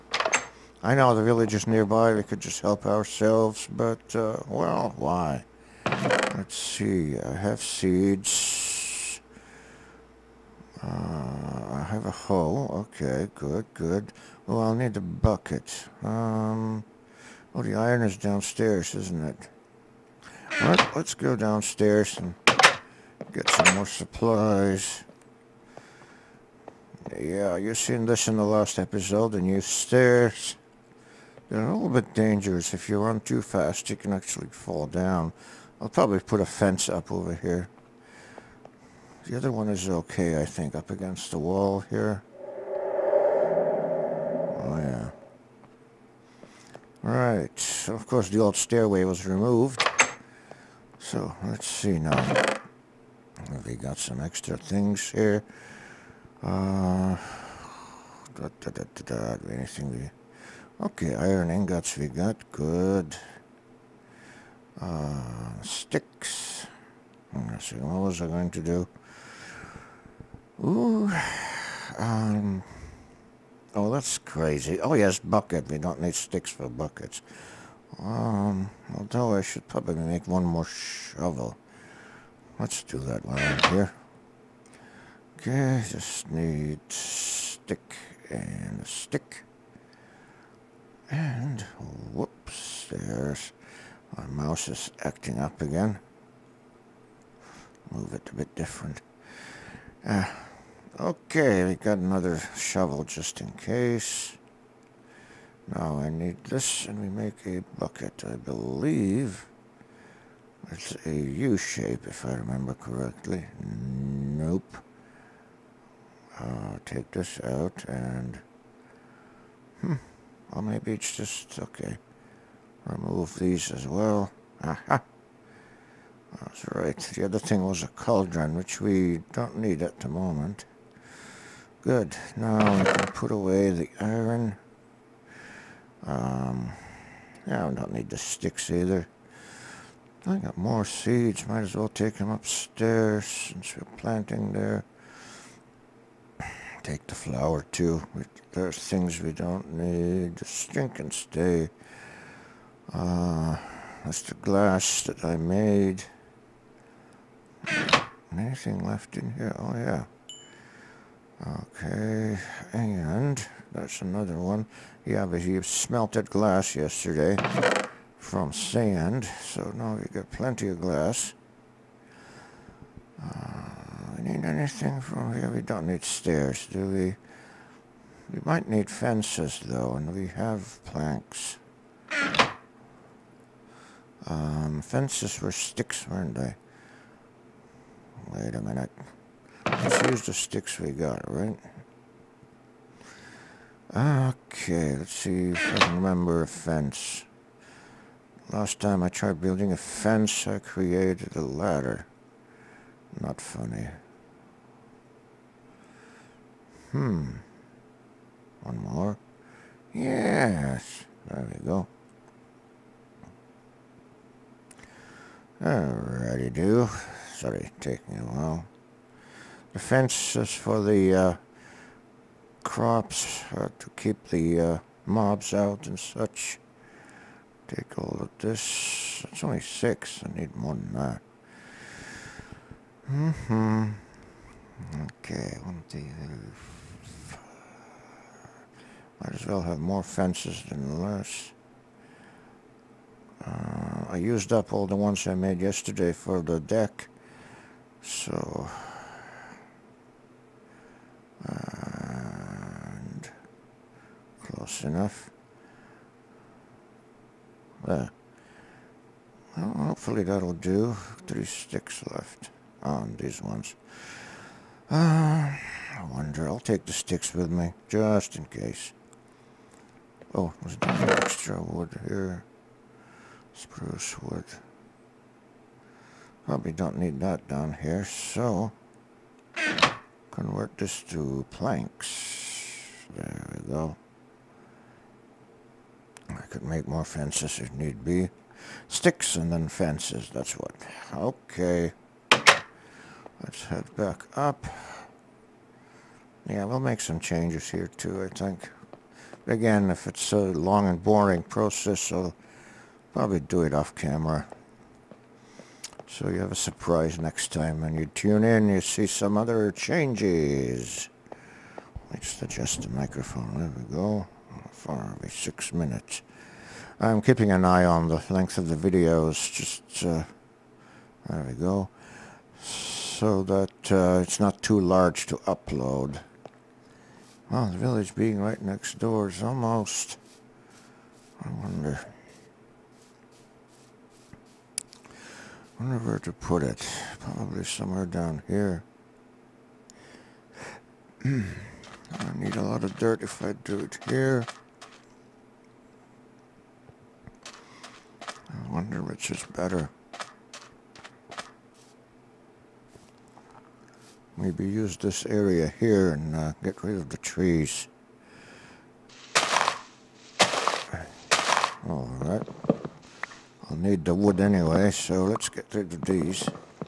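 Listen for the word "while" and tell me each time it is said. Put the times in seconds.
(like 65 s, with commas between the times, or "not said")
83 s, 218 s.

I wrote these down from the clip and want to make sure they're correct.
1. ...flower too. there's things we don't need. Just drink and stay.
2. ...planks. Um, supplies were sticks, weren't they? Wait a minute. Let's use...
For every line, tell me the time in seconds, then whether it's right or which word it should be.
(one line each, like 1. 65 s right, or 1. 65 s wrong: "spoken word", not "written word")
1. 147 s right
2. 180 s wrong: "fences", not "supplies".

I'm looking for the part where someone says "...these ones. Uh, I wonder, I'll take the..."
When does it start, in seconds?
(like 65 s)
263 s.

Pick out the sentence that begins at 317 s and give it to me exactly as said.
I'm keeping an eye on the length of the videos.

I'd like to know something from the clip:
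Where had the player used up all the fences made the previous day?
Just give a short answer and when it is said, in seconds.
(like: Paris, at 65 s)
the deck, at 246 s.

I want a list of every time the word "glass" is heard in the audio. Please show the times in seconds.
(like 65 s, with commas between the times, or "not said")
154 s, 166 s, 170 s.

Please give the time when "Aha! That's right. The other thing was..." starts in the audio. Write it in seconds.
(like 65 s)
124 s.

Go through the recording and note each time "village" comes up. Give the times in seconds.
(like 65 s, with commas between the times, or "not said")
1 s, 327 s.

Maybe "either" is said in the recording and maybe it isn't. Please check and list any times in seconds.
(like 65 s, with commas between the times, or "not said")
138 s.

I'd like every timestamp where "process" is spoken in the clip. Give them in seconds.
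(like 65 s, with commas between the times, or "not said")
301 s.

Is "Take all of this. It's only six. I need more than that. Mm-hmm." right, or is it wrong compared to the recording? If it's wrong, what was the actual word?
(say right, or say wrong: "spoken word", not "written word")
right.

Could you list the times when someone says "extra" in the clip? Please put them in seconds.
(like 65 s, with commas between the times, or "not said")
54 s, 270 s.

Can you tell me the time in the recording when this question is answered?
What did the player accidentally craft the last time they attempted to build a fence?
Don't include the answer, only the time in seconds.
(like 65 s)
201 s.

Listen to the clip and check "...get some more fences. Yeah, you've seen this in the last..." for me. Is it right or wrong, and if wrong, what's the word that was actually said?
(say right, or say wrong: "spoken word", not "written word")
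wrong: "supplies", not "fences".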